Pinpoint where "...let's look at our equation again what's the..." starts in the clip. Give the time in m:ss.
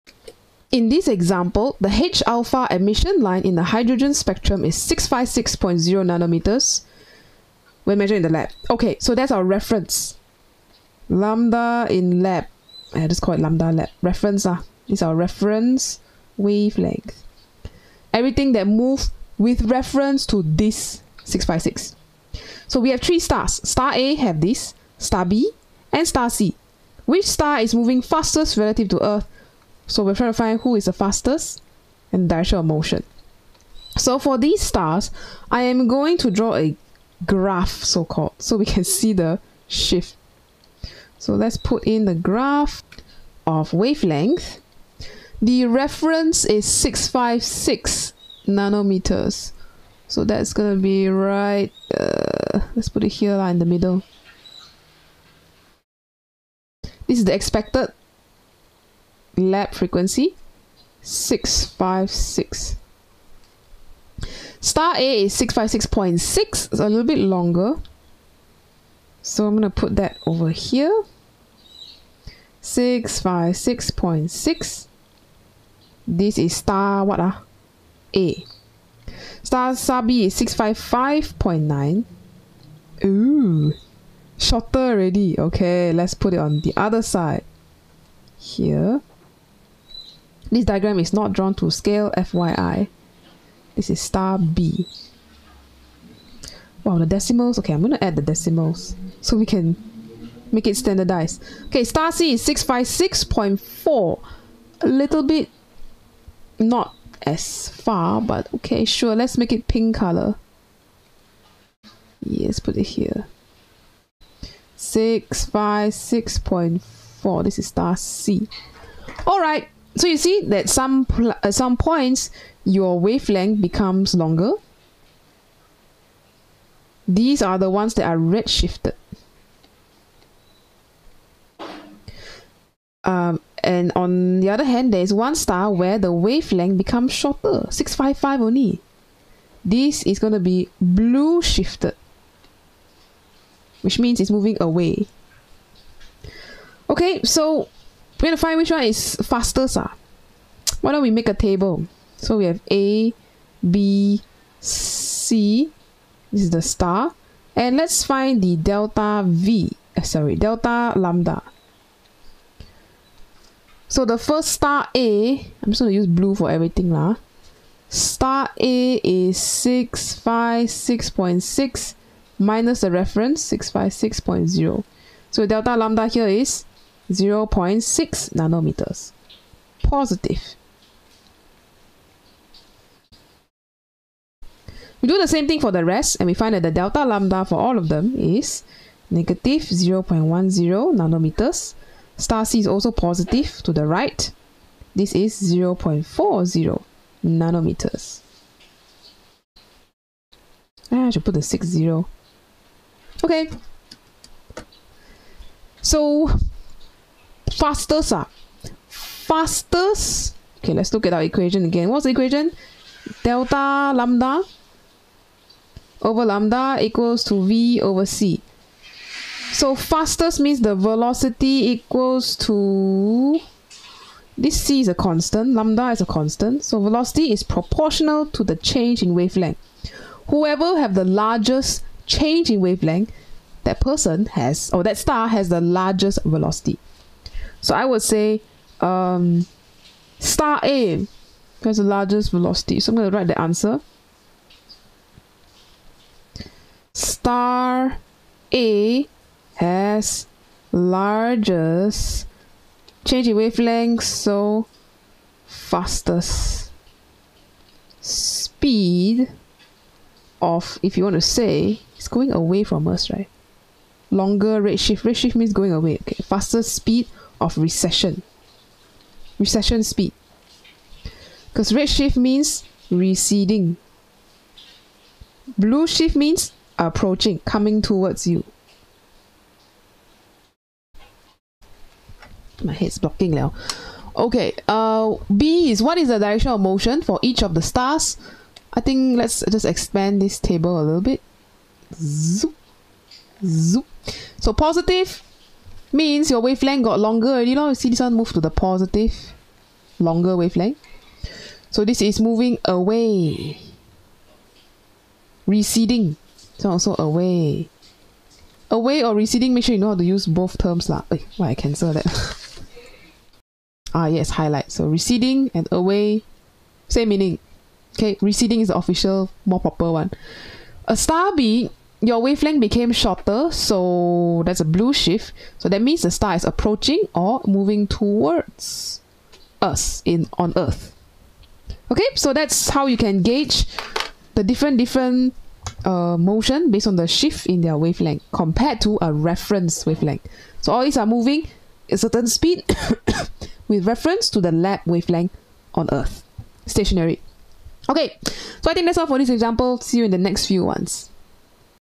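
3:30.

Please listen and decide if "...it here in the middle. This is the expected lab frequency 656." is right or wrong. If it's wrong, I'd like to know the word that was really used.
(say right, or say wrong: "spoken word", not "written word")
right.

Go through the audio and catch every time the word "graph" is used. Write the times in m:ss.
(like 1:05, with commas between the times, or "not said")
0:37, 0:42.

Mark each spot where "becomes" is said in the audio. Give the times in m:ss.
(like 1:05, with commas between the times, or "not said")
2:03, 2:16.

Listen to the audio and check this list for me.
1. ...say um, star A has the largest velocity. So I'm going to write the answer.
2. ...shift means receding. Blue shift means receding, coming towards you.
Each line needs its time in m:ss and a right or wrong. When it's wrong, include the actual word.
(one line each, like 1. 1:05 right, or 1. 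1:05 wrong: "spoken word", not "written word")
1. 3:58 right
2. 4:31 wrong: "approaching", not "receding".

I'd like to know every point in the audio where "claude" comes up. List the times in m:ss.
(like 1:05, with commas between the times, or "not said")
not said.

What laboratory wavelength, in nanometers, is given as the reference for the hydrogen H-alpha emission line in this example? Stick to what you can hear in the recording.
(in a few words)
656.0.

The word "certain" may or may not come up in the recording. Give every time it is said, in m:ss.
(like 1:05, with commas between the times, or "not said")
5:41.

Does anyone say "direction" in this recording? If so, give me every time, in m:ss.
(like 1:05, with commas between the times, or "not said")
0:32, 4:46.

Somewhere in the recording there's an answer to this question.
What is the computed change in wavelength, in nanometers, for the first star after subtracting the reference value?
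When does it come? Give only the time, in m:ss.
2:57.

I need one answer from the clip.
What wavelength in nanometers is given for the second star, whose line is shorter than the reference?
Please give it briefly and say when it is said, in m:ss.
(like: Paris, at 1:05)
655.9, at 1:20.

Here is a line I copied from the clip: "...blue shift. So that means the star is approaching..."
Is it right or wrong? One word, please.
right.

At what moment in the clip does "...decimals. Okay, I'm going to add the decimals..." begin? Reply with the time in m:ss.
1:37.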